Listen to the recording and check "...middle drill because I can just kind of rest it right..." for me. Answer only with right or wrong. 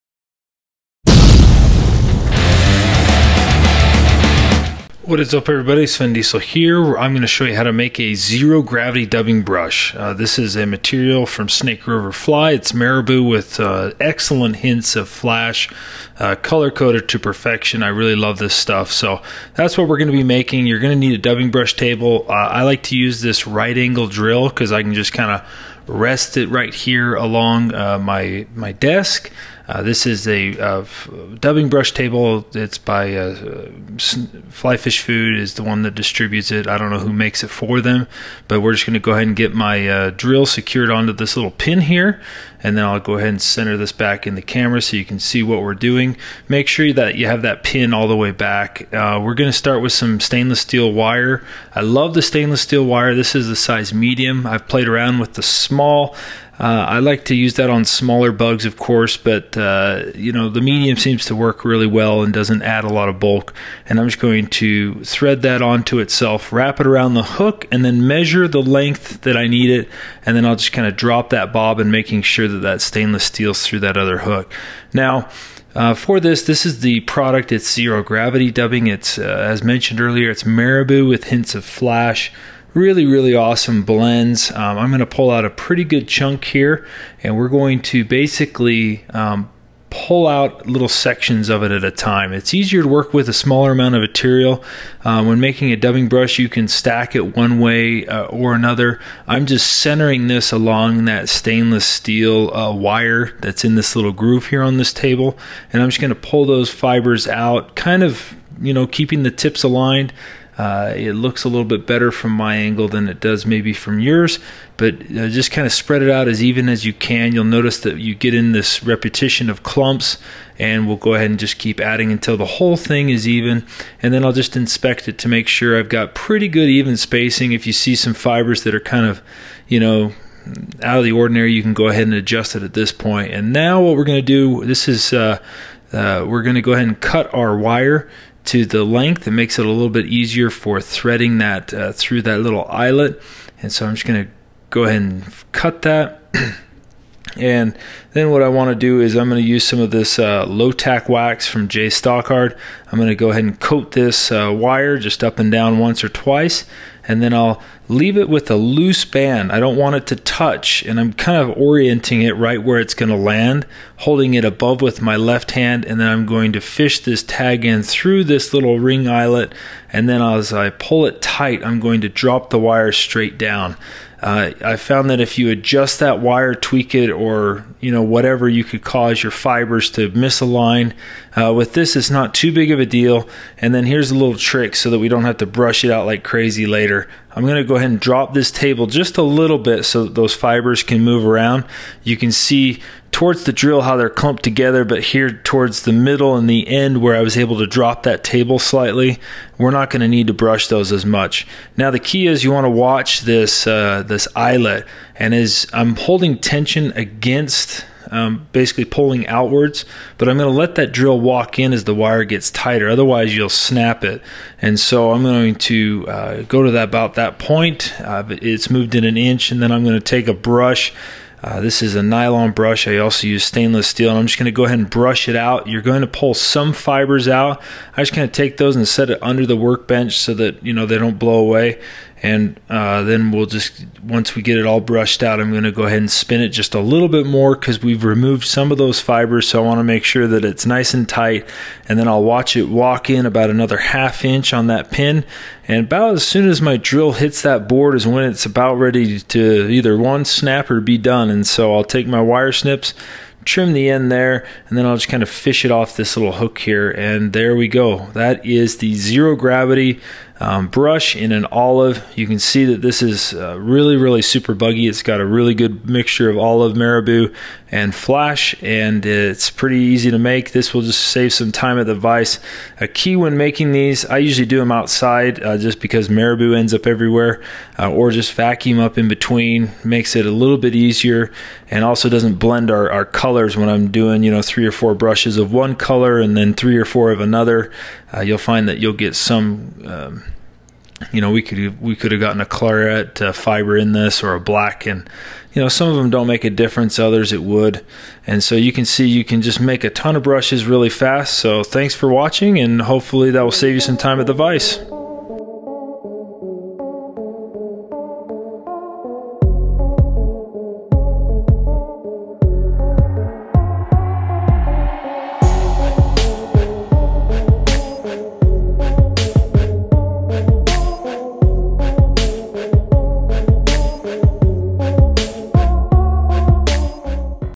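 wrong.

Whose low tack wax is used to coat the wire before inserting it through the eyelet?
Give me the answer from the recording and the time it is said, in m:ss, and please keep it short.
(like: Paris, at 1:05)
J Stockard, at 2:31.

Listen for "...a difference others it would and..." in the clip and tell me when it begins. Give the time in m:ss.
4:56.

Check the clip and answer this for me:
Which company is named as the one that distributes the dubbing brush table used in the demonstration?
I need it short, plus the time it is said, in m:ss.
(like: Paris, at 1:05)
Flyfish Food, at 0:34.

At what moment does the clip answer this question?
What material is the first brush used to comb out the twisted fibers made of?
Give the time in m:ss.
3:42.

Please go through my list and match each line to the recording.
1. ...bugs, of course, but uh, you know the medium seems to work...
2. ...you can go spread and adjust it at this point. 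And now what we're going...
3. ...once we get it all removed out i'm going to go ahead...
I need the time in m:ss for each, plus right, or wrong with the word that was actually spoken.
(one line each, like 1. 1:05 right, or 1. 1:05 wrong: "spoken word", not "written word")
1. 0:58 right
2. 2:11 wrong: "ahead", not "spread"
3. 3:54 wrong: "brushed", not "removed".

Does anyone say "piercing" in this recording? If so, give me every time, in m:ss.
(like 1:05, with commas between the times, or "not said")
not said.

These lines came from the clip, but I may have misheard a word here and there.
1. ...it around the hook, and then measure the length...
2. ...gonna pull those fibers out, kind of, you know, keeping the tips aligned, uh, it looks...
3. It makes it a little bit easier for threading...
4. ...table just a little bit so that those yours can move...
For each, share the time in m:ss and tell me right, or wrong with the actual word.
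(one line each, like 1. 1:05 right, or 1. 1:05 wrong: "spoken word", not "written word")
1. 1:06 right
2. 1:45 right
3. 2:19 right
4. 3:08 wrong: "fibers", not "yours".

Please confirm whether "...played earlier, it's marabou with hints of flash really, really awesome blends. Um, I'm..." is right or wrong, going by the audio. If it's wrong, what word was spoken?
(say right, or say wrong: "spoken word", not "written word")
wrong: "mentioned", not "played".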